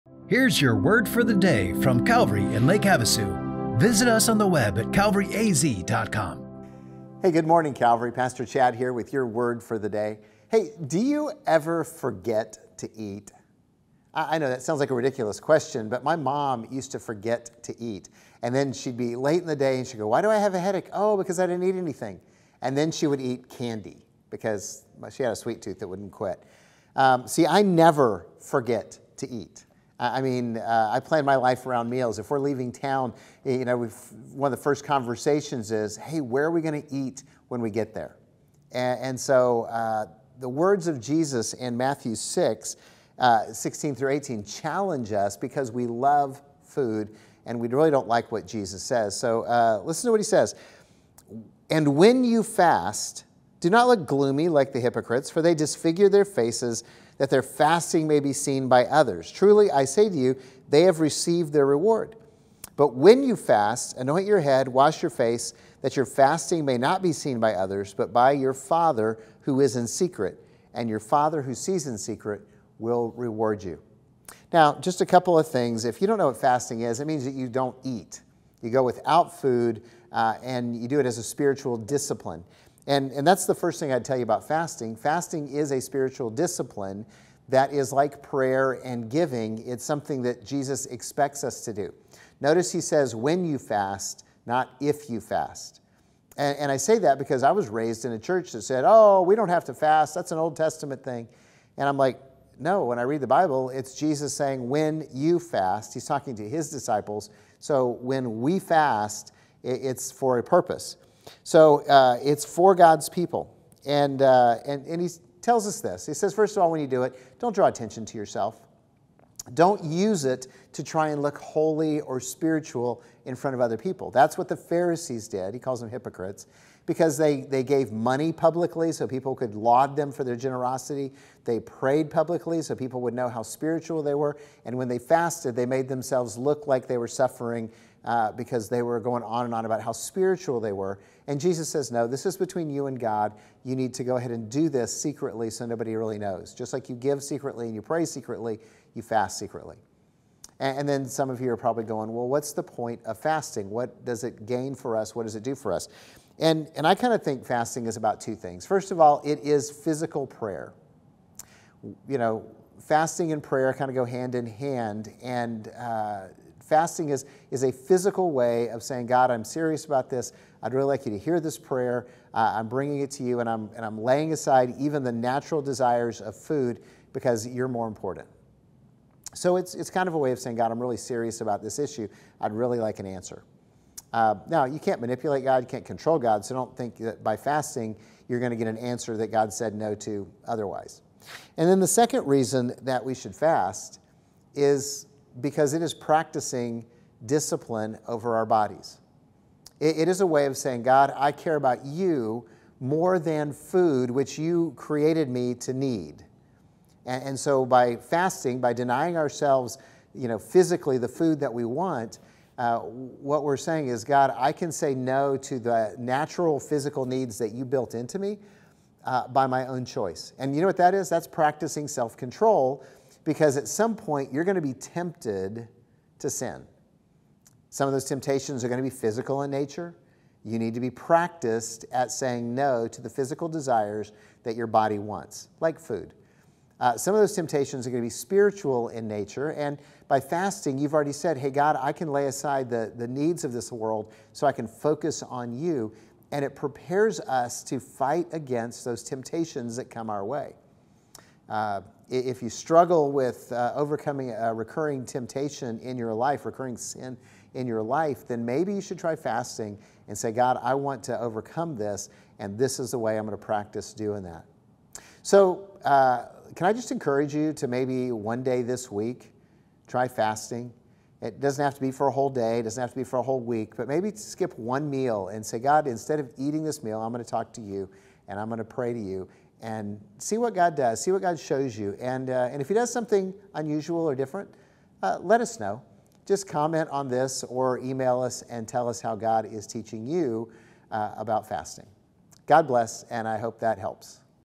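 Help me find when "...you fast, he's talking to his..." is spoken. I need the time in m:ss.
1:45.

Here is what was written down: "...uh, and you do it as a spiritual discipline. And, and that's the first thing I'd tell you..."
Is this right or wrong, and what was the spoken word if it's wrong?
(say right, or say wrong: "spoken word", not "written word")
right.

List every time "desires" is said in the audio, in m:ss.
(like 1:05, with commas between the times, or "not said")
2:55, 3:53.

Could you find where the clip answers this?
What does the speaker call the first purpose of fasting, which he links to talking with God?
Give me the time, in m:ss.
2:39.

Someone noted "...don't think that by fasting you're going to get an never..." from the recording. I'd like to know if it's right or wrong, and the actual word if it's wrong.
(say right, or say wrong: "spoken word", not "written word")
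wrong: "answer", not "never".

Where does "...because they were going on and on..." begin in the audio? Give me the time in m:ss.
2:18.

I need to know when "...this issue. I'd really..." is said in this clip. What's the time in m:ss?
3:01.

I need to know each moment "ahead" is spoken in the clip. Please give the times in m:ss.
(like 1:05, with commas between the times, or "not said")
2:24.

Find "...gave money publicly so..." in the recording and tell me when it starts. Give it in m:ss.
2:07.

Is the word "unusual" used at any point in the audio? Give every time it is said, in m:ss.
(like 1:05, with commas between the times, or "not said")
4:43.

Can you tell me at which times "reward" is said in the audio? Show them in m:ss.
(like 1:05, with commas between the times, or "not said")
1:01, 1:13.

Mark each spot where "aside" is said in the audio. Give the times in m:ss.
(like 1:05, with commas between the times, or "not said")
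2:54, 4:02.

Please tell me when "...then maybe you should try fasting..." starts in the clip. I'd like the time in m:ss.
4:18.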